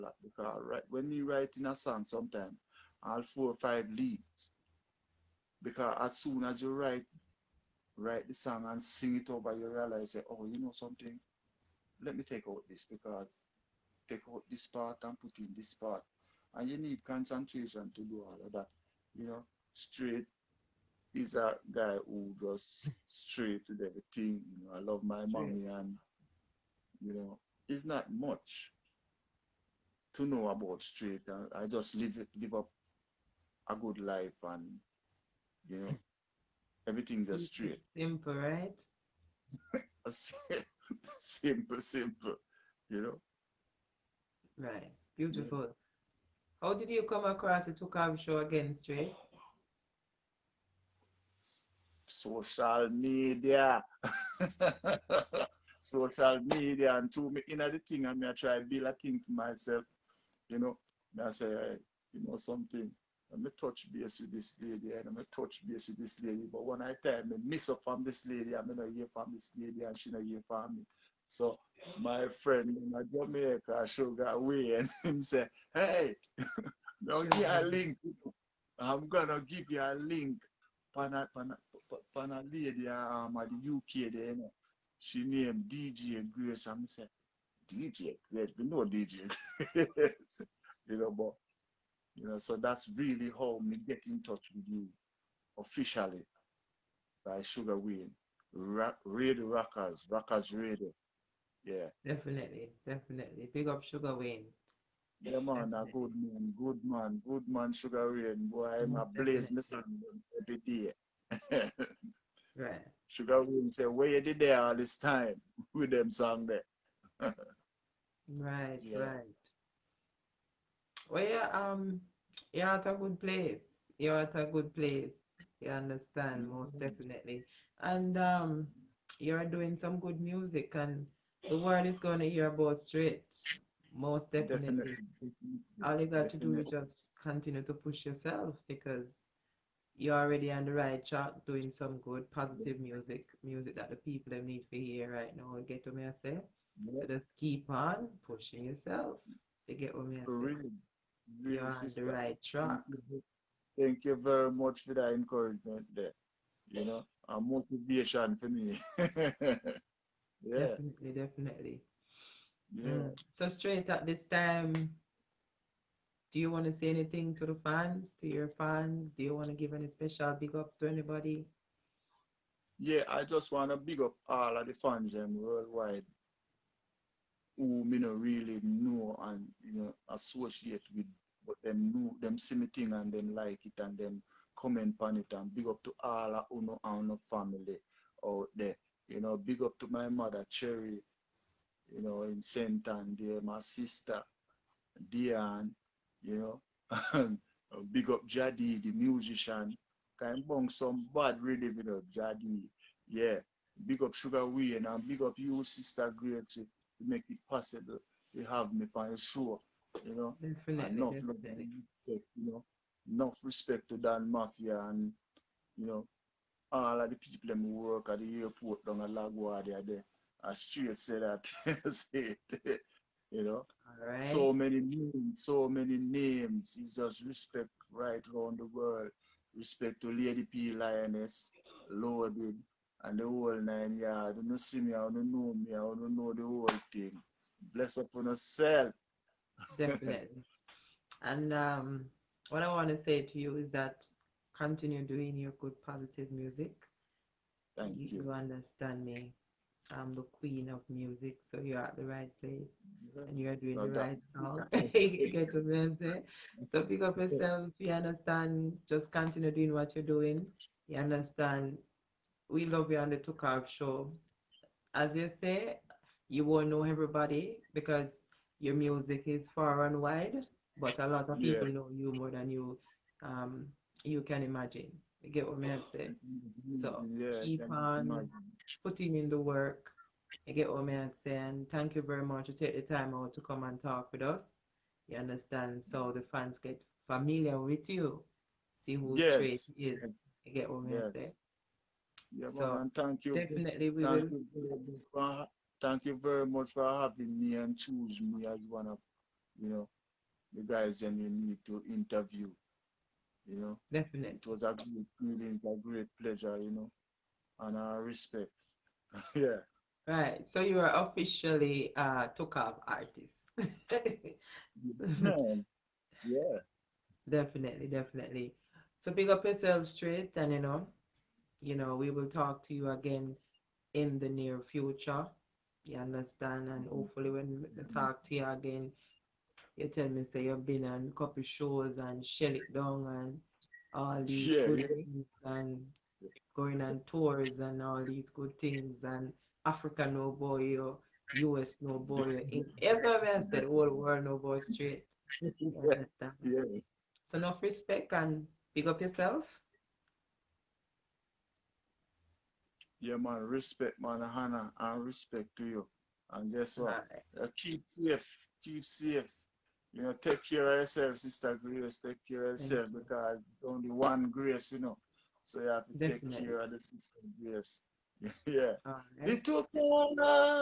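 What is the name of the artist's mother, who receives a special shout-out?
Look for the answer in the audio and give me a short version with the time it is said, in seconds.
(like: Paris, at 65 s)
Cherry, at 189 s.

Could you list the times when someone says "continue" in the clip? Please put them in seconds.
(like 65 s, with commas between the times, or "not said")
137 s, 244 s, 259 s.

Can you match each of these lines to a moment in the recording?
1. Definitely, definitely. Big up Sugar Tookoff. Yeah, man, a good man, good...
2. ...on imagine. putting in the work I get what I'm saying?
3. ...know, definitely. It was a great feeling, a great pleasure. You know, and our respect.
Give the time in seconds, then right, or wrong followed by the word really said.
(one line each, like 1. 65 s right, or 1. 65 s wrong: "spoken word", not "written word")
1. 102 s wrong: "Wayne", not "Tookoff"
2. 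277 s right
3. 303 s right.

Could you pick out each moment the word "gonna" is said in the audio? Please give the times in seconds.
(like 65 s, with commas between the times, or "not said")
79 s.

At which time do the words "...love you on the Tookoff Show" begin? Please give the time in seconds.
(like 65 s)
262 s.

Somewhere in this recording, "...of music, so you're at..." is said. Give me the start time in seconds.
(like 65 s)
250 s.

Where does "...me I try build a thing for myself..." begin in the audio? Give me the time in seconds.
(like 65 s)
58 s.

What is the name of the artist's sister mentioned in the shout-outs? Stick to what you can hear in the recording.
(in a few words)
Diane.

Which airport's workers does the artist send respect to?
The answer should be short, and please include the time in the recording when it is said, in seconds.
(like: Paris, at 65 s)
Lagua, at 218 s.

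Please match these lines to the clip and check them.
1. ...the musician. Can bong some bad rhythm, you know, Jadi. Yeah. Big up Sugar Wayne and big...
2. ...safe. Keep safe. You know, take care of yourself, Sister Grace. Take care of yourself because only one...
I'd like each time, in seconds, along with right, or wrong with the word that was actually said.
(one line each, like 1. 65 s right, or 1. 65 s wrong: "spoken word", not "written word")
1. 198 s right
2. 357 s right.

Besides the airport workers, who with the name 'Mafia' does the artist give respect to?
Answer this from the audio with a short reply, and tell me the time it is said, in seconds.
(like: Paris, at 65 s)
Dan Mafia, at 213 s.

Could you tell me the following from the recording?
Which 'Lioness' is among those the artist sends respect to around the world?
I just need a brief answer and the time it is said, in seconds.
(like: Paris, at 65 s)
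Lady P Lioness, at 230 s.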